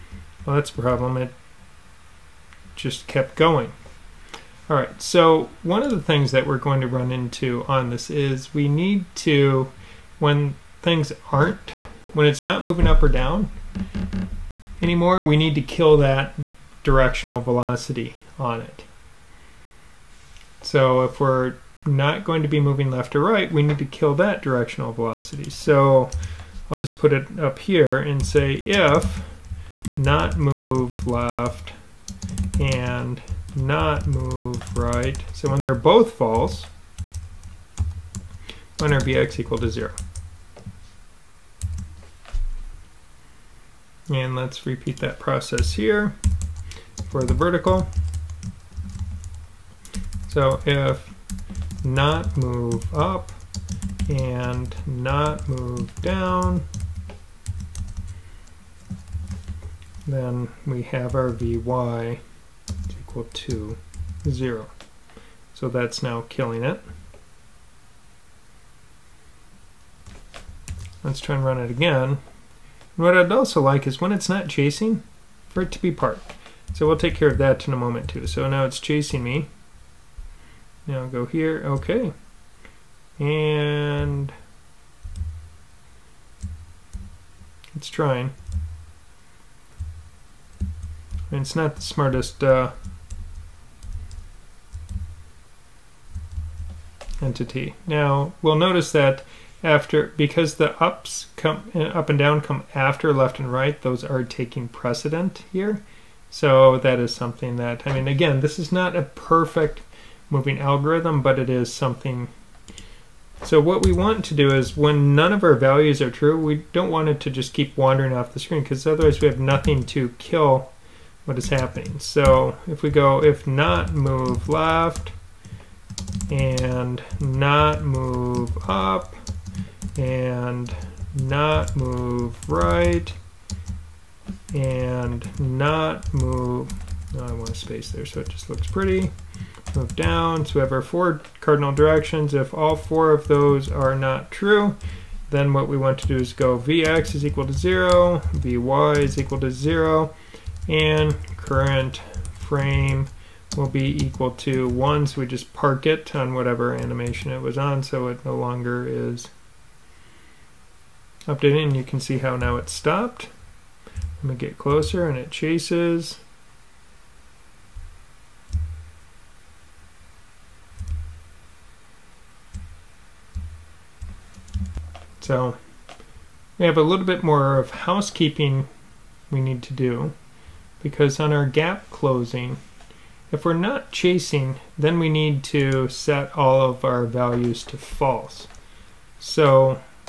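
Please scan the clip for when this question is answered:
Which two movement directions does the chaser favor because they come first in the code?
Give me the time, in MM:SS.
01:43.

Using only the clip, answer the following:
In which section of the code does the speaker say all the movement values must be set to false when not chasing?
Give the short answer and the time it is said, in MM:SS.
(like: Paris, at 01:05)
gap closing, at 03:01.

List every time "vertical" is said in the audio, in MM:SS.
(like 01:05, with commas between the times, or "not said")
00:47.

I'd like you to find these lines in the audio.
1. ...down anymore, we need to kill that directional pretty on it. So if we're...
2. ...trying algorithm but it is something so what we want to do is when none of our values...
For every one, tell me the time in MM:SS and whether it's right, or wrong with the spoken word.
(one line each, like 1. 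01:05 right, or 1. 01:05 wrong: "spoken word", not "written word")
1. 00:13 wrong: "velocity", not "pretty"
2. 01:50 wrong: "moving", not "trying".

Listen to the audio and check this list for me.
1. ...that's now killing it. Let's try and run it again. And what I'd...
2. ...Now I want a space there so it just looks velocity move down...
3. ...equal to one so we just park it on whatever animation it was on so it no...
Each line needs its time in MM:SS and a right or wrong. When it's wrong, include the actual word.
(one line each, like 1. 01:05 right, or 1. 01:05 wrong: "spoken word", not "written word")
1. 01:05 right
2. 02:17 wrong: "pretty", not "velocity"
3. 02:34 right.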